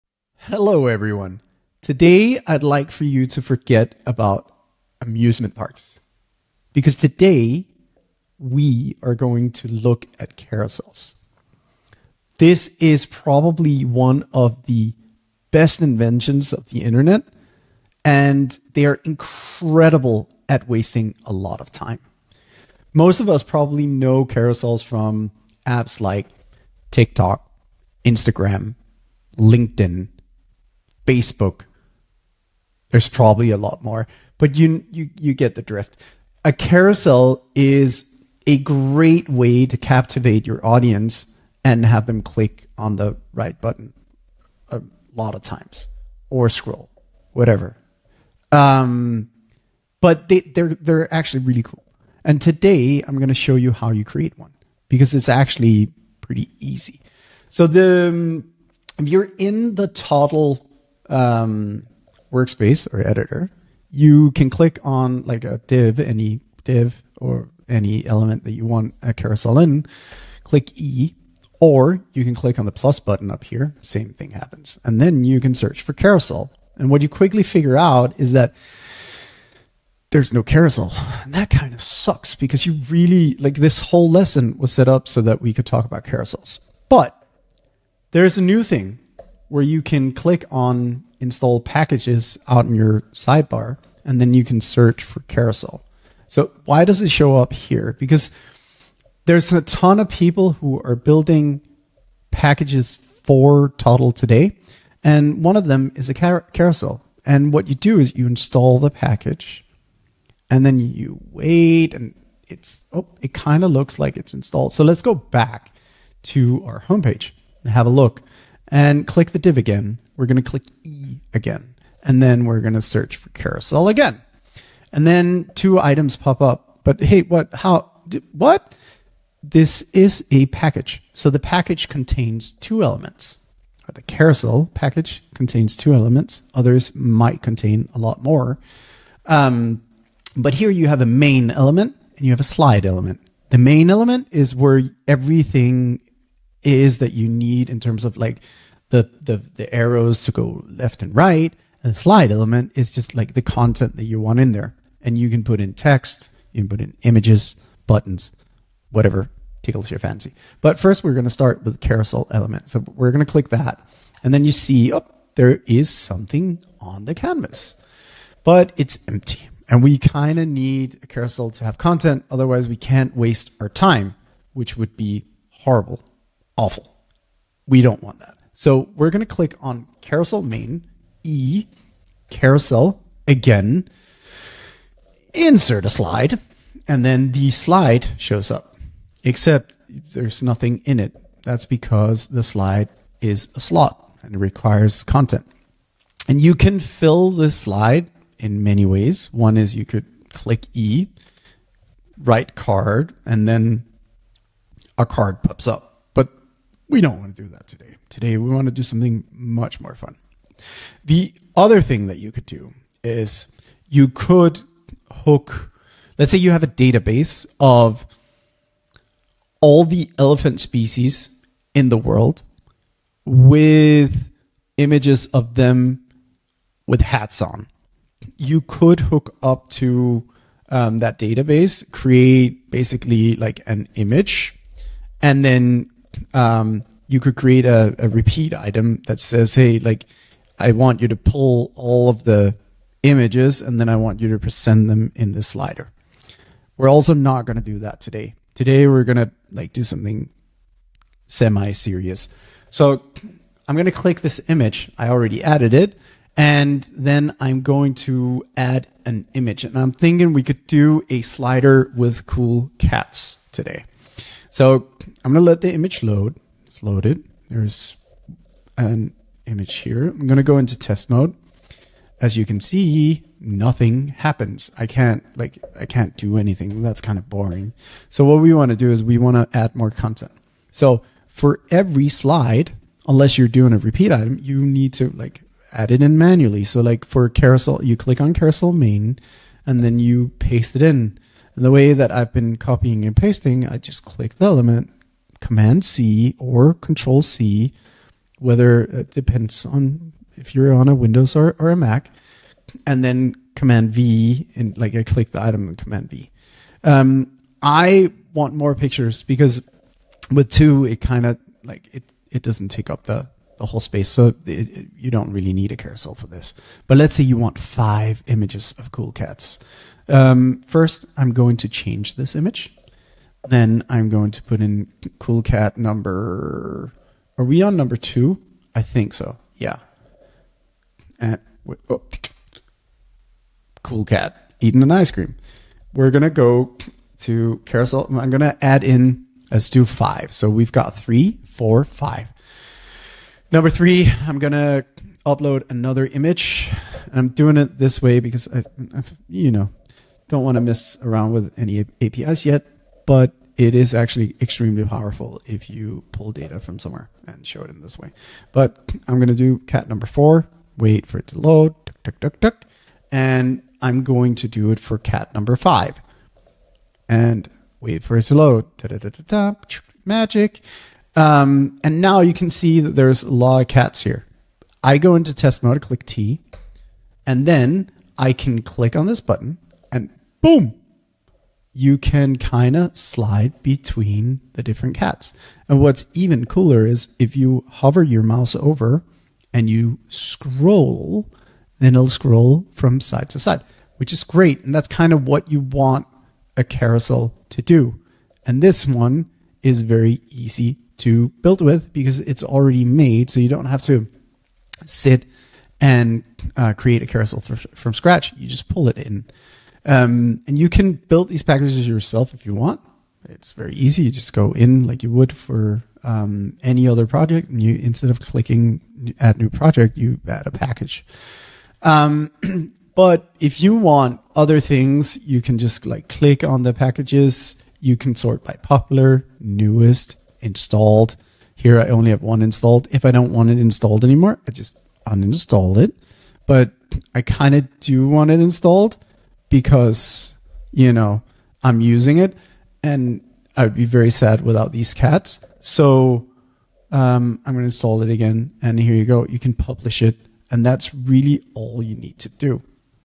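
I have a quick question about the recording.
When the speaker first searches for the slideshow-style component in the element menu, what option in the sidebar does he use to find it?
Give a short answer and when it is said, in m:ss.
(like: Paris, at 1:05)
install packages, at 1:31.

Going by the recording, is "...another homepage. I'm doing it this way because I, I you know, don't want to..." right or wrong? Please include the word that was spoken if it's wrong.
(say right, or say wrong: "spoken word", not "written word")
wrong: "image", not "homepage".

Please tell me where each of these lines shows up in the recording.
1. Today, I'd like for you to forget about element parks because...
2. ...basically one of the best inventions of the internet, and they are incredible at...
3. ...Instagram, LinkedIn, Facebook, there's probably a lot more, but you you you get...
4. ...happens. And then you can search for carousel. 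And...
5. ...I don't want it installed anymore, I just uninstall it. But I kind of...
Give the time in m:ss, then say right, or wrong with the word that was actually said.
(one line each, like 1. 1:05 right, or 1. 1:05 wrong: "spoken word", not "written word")
1. 0:01 wrong: "amusement", not "element"
2. 0:13 wrong: "probably", not "basically"
3. 0:28 right
4. 1:14 right
5. 7:13 right.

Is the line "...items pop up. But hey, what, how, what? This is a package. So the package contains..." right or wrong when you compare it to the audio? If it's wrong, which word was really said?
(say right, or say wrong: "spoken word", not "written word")
right.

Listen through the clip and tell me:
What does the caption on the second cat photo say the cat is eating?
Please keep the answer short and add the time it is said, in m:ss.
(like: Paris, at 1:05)
an ice cream, at 5:34.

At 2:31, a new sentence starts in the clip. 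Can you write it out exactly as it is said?
And the slide element is just like the content that you want in there.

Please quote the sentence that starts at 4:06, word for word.
We're also not going to do that today.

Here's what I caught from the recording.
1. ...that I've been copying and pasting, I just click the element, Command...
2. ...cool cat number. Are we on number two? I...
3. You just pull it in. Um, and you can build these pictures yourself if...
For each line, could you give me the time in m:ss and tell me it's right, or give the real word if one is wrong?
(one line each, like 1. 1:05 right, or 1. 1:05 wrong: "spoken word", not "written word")
1. 4:51 right
2. 5:25 right
3. 6:48 wrong: "packages", not "pictures".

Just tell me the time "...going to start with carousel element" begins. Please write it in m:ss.
2:41.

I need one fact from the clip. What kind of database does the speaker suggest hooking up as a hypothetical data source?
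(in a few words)
elephant species.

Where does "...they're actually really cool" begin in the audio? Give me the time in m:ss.
0:50.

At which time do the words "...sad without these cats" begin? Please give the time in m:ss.
7:24.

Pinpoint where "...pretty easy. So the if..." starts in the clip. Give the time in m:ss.
0:56.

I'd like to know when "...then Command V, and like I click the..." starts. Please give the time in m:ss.
5:03.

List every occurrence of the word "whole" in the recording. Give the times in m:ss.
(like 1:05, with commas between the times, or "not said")
1:23, 5:13.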